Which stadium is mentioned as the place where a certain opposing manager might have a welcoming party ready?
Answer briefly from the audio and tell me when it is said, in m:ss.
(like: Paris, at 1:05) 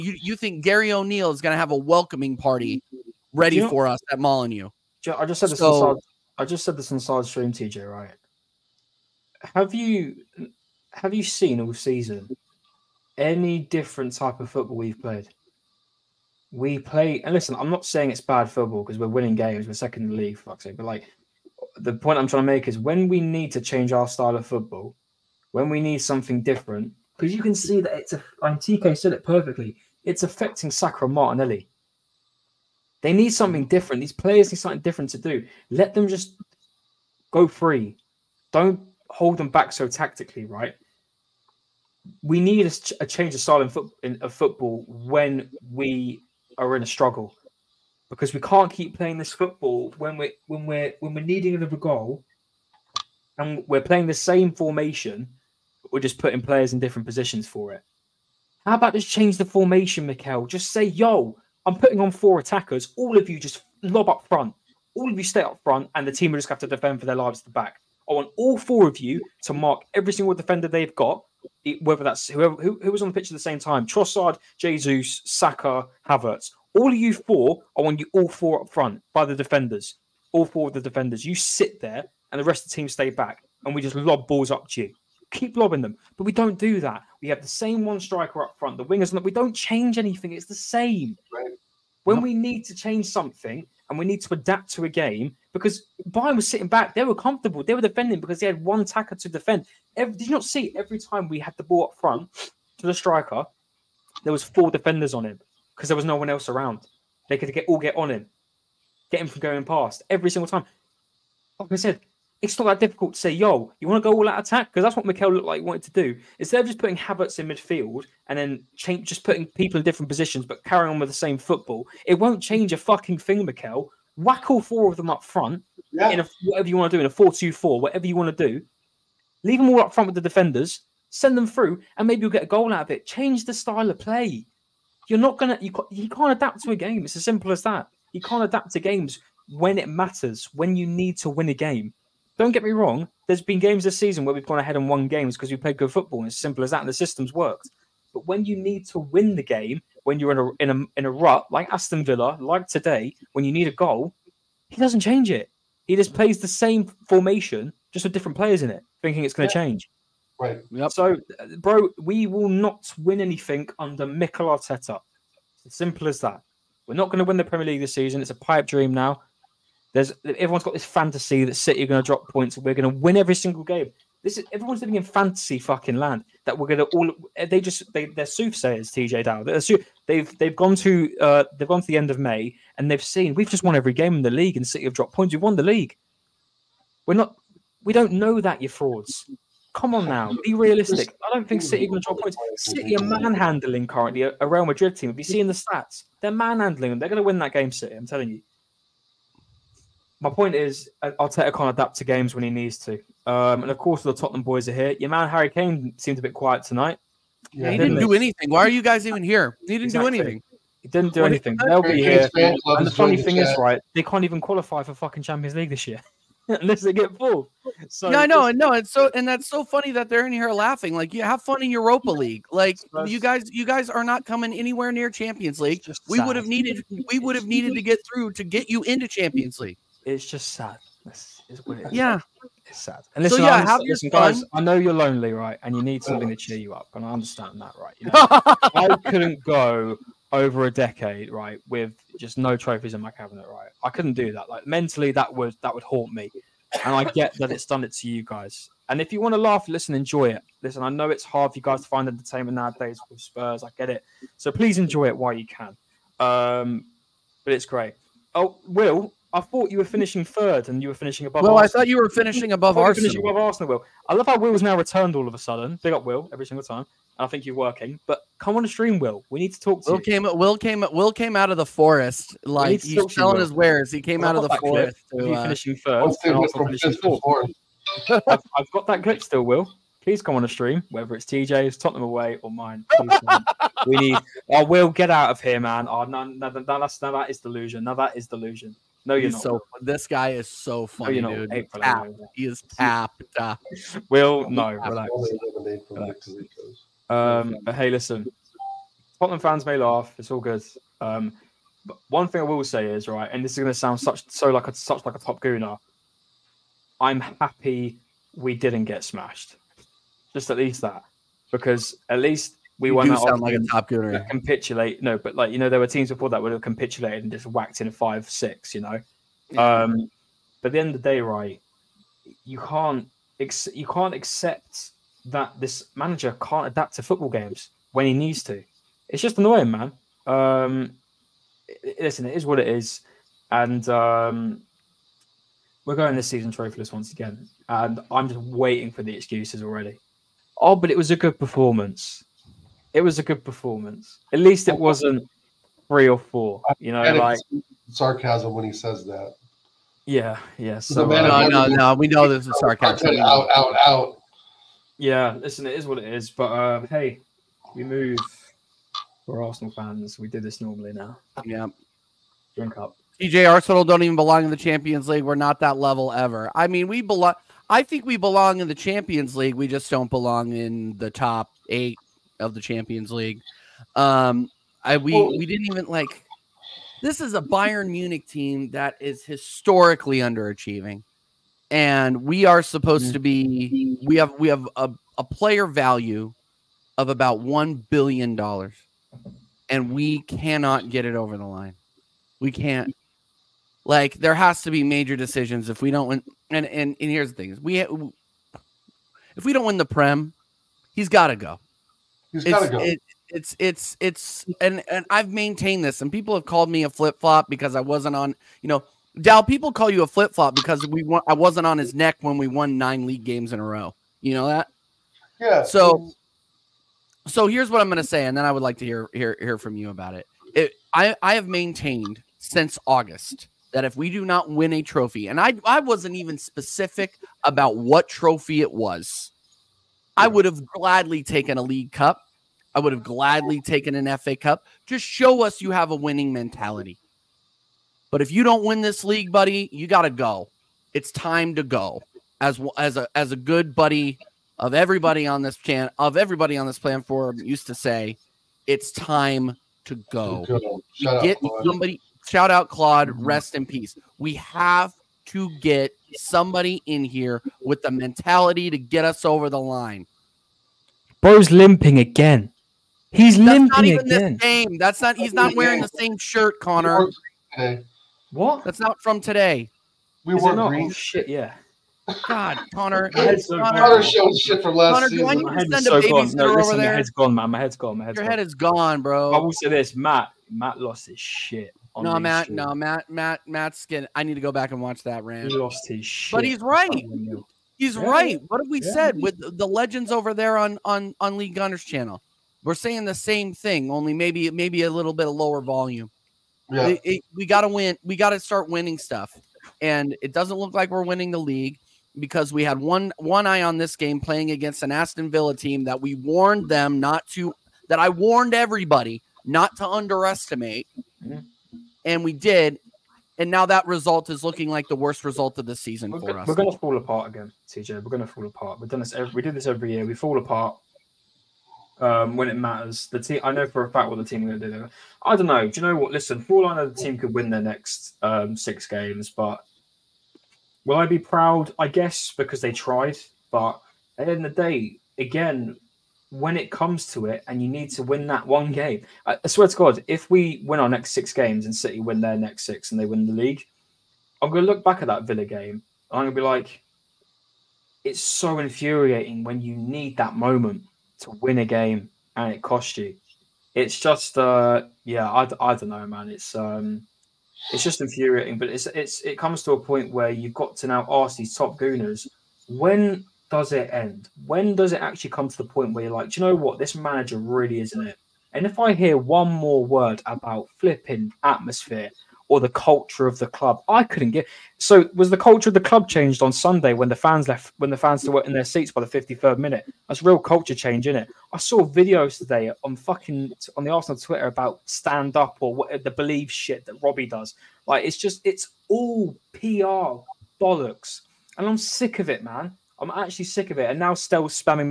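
Molineux, at 0:04.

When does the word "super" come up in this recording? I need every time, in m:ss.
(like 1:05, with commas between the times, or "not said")
not said.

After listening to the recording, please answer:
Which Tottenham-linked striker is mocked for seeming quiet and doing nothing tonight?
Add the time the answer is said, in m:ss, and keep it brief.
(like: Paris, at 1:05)
Harry Kane, at 3:25.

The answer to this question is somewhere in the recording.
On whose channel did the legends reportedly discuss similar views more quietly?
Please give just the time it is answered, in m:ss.
8:11.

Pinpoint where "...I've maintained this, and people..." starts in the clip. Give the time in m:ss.
6:45.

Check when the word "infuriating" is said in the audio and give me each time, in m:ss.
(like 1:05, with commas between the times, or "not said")
9:08, 9:17.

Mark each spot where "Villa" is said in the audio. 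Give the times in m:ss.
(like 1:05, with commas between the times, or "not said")
2:32, 8:25, 9:05.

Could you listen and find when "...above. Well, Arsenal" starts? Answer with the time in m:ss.
4:21.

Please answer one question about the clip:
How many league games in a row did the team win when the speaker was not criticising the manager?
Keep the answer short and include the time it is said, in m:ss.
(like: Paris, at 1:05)
9, at 6:52.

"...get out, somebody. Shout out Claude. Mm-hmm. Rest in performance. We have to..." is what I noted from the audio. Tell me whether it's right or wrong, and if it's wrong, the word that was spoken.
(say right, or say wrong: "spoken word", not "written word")
wrong: "peace", not "performance".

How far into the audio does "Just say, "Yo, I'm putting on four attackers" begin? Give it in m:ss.
1:00.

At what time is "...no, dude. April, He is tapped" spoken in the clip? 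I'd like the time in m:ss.
4:51.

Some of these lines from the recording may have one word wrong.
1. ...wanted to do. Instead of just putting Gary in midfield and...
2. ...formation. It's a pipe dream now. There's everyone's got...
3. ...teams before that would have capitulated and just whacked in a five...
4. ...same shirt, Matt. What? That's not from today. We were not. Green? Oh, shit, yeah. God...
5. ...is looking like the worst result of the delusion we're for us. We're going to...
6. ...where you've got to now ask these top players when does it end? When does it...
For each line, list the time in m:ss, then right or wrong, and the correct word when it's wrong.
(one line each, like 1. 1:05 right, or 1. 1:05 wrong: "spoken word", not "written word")
1. 1:55 wrong: "Havertz", not "Gary"
2. 2:47 wrong: "season", not "formation"
3. 5:15 right
4. 7:45 wrong: "Connor", not "Matt"
5. 8:34 wrong: "season", not "delusion"
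6. 9:20 wrong: "gooners", not "players".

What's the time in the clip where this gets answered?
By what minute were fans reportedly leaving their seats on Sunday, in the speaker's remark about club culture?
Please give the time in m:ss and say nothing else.
9:39.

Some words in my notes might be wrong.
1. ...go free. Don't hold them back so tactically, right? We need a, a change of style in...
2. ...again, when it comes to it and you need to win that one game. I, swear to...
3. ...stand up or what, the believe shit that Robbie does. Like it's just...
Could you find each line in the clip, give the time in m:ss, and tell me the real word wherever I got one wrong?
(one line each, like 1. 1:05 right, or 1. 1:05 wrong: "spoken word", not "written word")
1. 0:37 right
2. 8:55 right
3. 9:44 right.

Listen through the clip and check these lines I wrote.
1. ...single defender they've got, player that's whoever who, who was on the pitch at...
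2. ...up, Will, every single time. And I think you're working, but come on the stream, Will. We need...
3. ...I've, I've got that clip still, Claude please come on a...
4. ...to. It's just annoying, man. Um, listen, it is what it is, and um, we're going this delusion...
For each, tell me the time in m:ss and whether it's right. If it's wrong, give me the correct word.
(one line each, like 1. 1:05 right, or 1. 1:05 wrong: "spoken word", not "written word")
1. 1:10 wrong: "whether", not "player"
2. 4:25 right
3. 4:38 wrong: "Will", not "Claude"
4. 5:28 wrong: "season", not "delusion".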